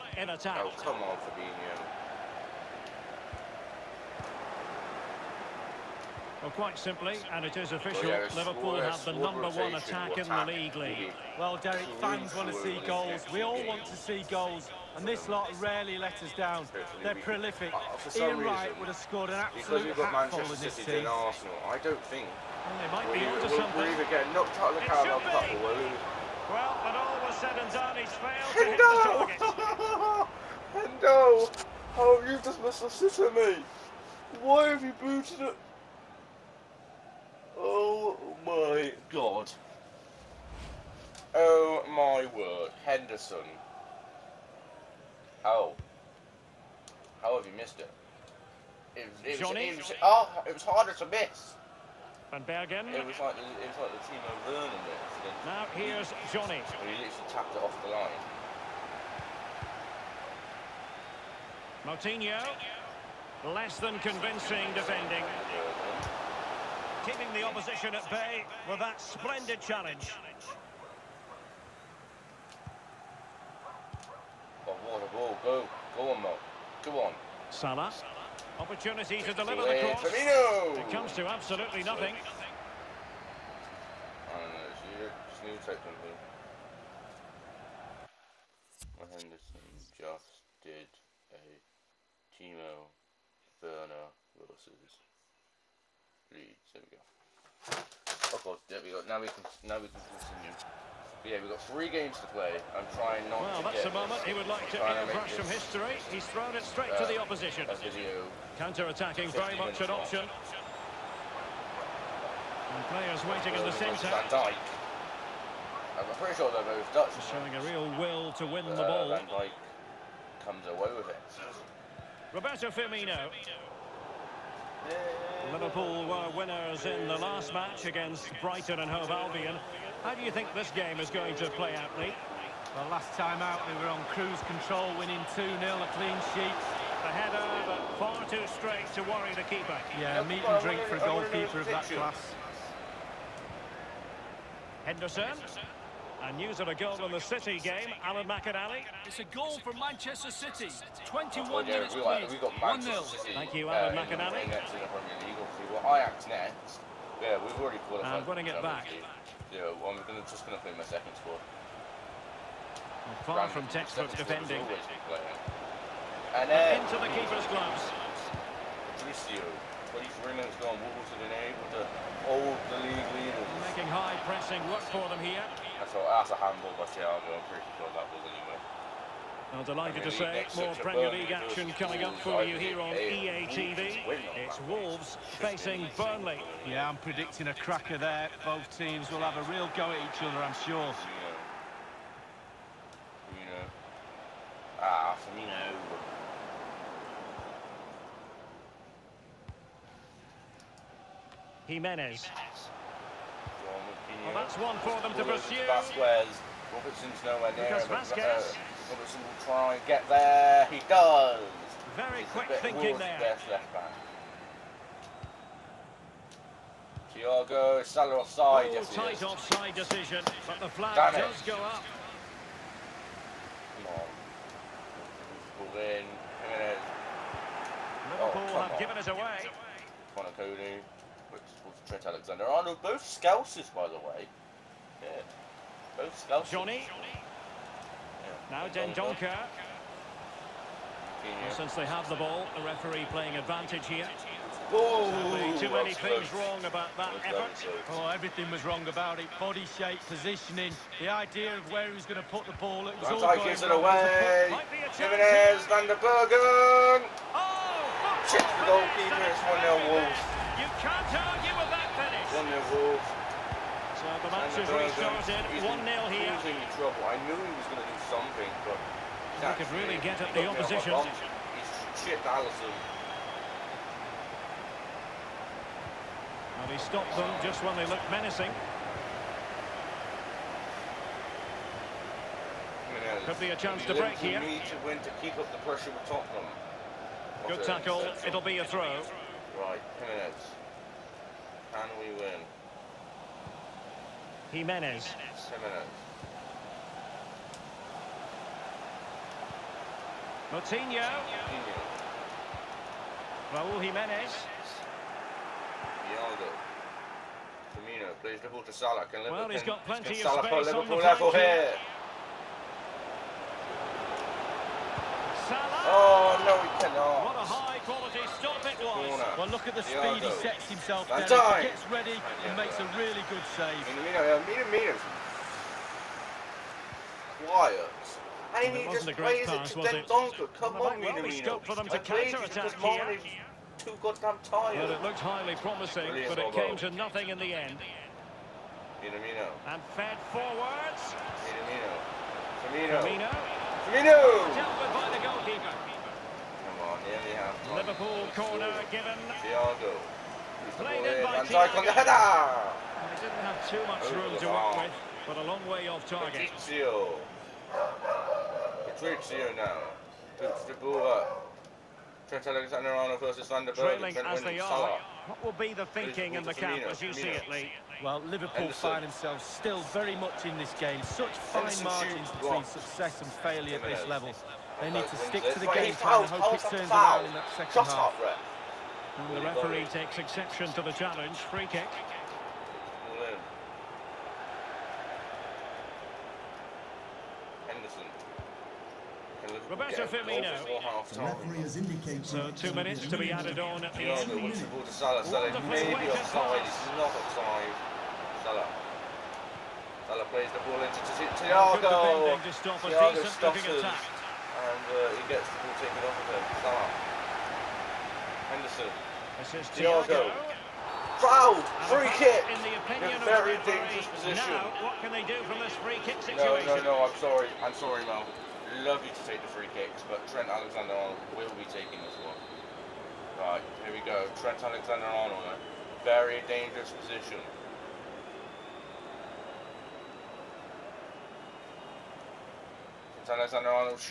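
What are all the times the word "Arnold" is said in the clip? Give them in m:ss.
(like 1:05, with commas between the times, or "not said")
3:52, 6:02, 7:00, 7:04.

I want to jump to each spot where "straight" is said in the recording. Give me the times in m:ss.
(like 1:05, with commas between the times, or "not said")
1:46, 2:18.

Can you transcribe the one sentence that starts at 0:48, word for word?
It, it, Johnny, was, it was, oh, it was harder to miss.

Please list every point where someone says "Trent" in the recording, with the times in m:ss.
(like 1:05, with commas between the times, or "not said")
3:51, 6:02, 7:00, 7:04.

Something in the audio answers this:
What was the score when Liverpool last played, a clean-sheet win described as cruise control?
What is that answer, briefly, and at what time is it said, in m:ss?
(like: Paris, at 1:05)
2-0, at 2:15.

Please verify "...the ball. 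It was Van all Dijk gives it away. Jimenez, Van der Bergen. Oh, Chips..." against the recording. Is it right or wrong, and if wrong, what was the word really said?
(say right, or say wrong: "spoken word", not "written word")
right.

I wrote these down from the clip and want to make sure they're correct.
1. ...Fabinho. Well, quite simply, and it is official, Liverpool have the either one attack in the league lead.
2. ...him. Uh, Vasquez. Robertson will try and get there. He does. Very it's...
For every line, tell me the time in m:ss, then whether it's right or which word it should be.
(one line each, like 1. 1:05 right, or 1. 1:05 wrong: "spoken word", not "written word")
1. 0:01 wrong: "number", not "either"
2. 3:27 right.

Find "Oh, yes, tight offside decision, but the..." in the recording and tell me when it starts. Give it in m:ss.
3:38.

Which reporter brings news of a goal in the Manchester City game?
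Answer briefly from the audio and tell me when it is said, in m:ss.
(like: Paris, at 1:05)
Alan McInally, at 2:28.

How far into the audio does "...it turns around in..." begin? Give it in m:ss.
6:16.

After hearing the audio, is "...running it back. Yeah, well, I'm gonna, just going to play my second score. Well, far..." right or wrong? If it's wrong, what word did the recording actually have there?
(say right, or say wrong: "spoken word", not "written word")
right.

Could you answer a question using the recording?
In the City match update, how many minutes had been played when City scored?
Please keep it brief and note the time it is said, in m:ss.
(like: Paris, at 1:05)
21, at 2:31.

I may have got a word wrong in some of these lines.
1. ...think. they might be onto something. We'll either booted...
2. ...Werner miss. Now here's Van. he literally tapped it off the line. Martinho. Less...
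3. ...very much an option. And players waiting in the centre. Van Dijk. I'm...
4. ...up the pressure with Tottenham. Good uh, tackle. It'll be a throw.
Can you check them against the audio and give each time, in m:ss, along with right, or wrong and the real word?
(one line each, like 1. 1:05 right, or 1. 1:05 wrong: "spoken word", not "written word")
1. 0:22 wrong: "knocked", not "booted"
2. 0:54 wrong: "Johnny", not "Van"
3. 1:49 right
4. 4:45 right.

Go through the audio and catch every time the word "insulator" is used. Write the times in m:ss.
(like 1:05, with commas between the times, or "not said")
not said.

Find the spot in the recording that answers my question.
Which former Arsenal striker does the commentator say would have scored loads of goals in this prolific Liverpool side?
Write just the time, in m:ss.
0:18.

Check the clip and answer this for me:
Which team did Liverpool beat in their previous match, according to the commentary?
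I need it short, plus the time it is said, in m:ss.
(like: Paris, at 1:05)
Brighton and Hove Albion, at 2:08.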